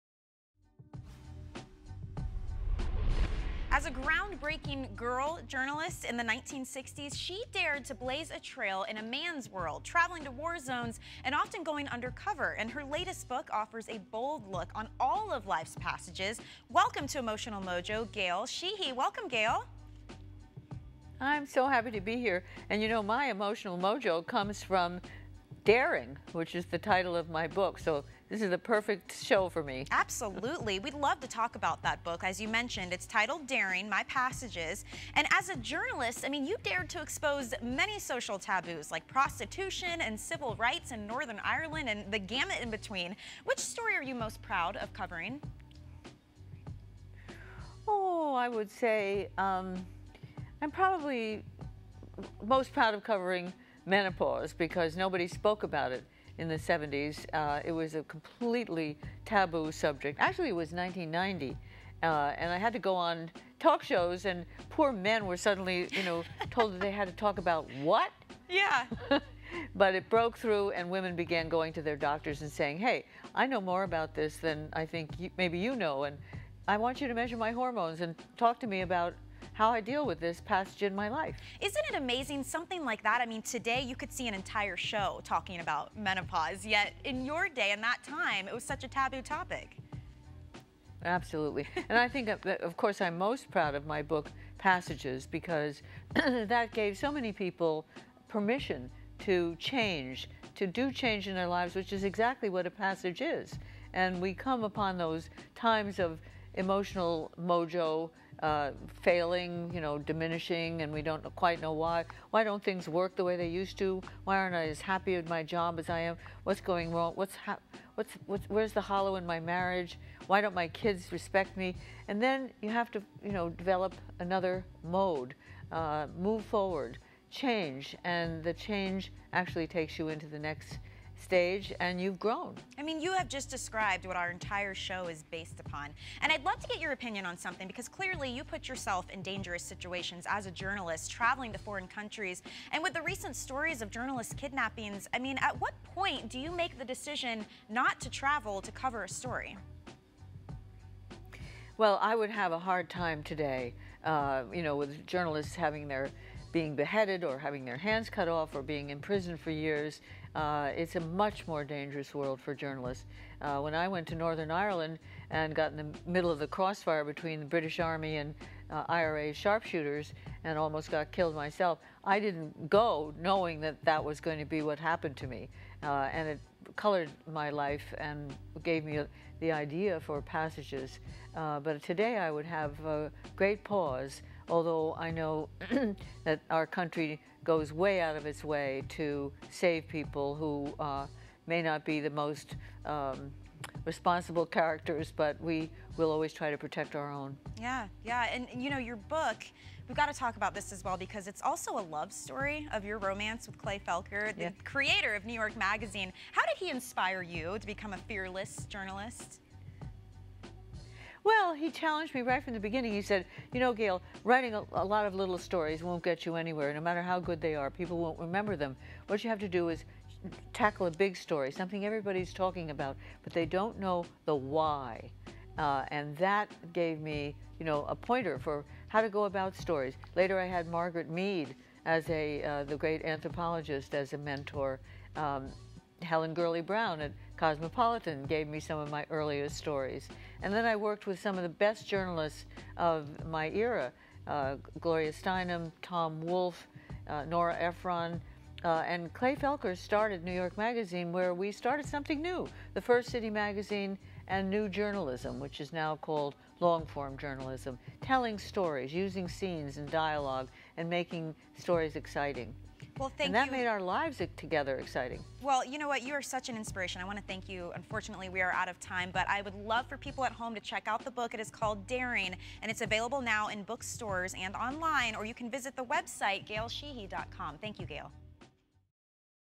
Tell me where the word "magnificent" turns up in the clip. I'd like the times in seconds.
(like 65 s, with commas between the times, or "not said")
not said.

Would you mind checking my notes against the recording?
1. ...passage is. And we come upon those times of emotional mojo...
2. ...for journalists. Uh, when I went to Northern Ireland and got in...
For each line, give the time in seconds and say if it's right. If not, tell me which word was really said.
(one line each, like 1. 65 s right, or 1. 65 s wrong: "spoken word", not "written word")
1. 102 s right
2. 162 s right.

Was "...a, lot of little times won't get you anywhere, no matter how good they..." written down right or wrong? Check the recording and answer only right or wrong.
wrong.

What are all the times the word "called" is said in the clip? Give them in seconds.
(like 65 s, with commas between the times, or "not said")
255 s, 271 s.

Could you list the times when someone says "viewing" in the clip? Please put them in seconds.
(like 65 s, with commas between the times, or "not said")
not said.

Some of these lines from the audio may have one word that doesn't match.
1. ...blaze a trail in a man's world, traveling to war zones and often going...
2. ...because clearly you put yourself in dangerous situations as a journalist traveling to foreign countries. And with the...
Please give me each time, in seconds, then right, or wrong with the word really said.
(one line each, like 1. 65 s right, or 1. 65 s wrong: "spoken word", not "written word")
1. 7 s right
2. 137 s right.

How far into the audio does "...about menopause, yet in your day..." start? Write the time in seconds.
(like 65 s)
85 s.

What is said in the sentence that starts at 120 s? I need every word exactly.
Why don't my kids respect me?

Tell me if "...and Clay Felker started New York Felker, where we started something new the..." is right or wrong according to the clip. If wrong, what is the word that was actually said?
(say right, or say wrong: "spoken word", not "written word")
wrong: "Magazine", not "Felker".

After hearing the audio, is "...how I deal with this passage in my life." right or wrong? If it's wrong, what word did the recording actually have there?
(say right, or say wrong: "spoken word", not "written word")
right.